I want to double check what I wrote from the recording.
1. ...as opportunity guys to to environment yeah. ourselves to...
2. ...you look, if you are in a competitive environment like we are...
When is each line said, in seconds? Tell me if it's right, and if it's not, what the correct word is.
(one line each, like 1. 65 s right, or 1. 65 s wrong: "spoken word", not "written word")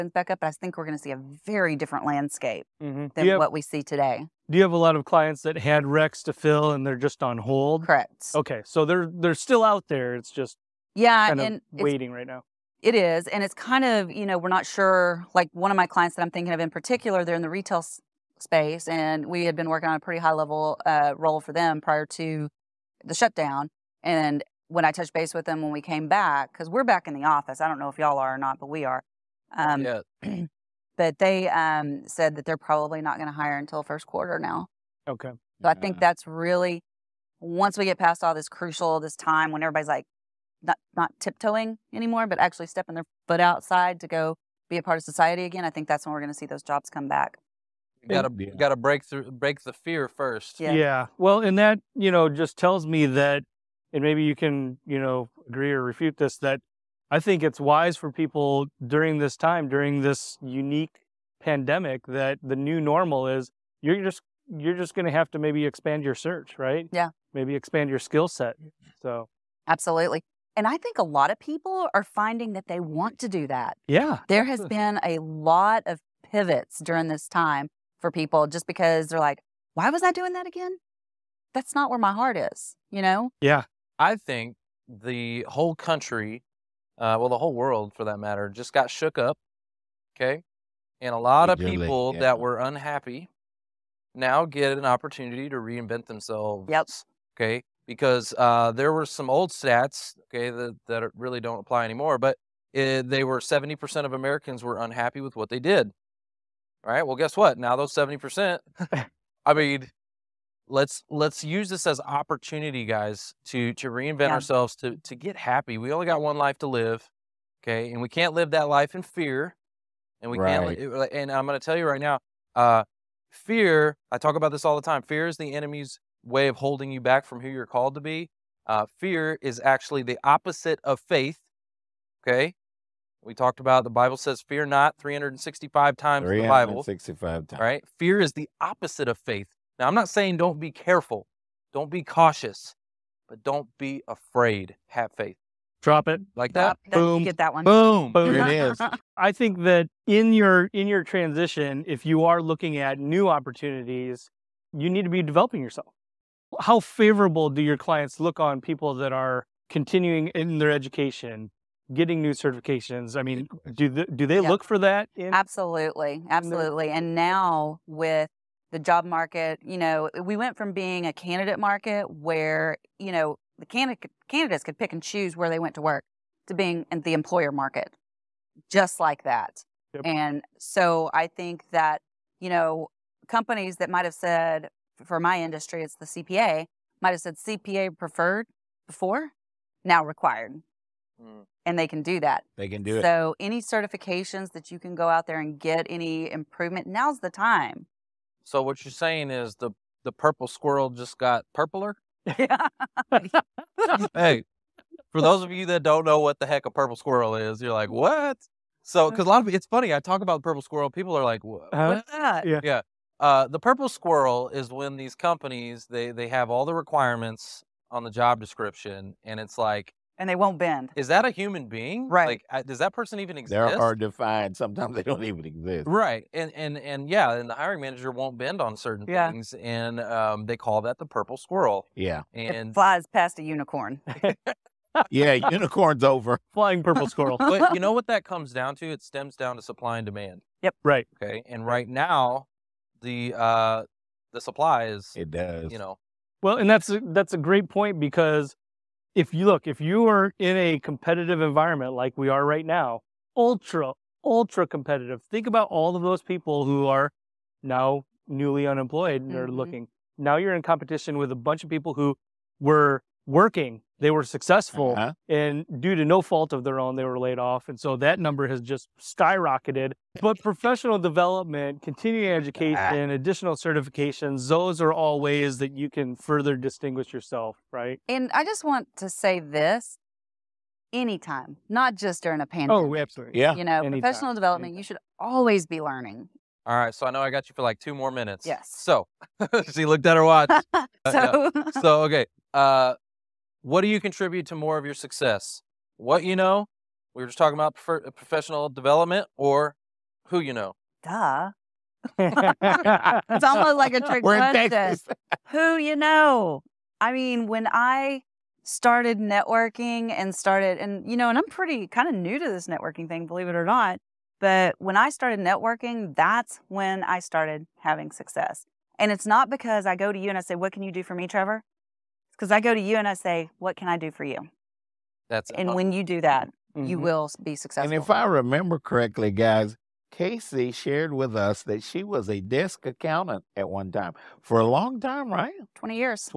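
1. 111 s wrong: "reinvent", not "environment"
2. 249 s right.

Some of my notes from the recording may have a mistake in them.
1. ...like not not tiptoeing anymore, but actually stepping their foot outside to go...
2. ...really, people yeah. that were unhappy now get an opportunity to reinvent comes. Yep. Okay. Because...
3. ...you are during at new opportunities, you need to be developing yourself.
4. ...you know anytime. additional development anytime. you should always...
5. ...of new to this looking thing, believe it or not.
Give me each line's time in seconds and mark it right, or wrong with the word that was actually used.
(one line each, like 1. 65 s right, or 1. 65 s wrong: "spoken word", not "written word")
1. 39 s right
2. 91 s wrong: "themselves", not "comes"
3. 152 s wrong: "looking", not "during"
4. 283 s wrong: "professional", not "additional"
5. 312 s wrong: "networking", not "looking".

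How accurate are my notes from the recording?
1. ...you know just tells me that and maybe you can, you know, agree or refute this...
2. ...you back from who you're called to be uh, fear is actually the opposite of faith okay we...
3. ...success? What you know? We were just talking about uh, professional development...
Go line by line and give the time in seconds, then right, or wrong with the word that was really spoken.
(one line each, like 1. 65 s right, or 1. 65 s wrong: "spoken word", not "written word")
1. 51 s right
2. 126 s right
3. 294 s right.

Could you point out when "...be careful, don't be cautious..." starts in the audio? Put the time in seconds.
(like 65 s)
140 s.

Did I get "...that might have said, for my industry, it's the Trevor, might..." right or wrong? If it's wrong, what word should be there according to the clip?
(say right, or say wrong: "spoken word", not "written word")
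wrong: "CPA", not "Trevor".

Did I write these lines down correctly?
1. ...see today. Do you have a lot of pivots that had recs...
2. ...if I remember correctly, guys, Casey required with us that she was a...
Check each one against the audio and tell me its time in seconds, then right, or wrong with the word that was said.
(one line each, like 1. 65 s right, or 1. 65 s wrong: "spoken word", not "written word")
1. 3 s wrong: "clients", not "pivots"
2. 328 s wrong: "shared", not "required".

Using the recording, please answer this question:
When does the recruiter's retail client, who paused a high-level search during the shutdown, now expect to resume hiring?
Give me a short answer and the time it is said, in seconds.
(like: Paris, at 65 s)
First quarter, at 33 s.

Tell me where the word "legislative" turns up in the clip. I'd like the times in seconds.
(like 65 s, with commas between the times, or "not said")
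not said.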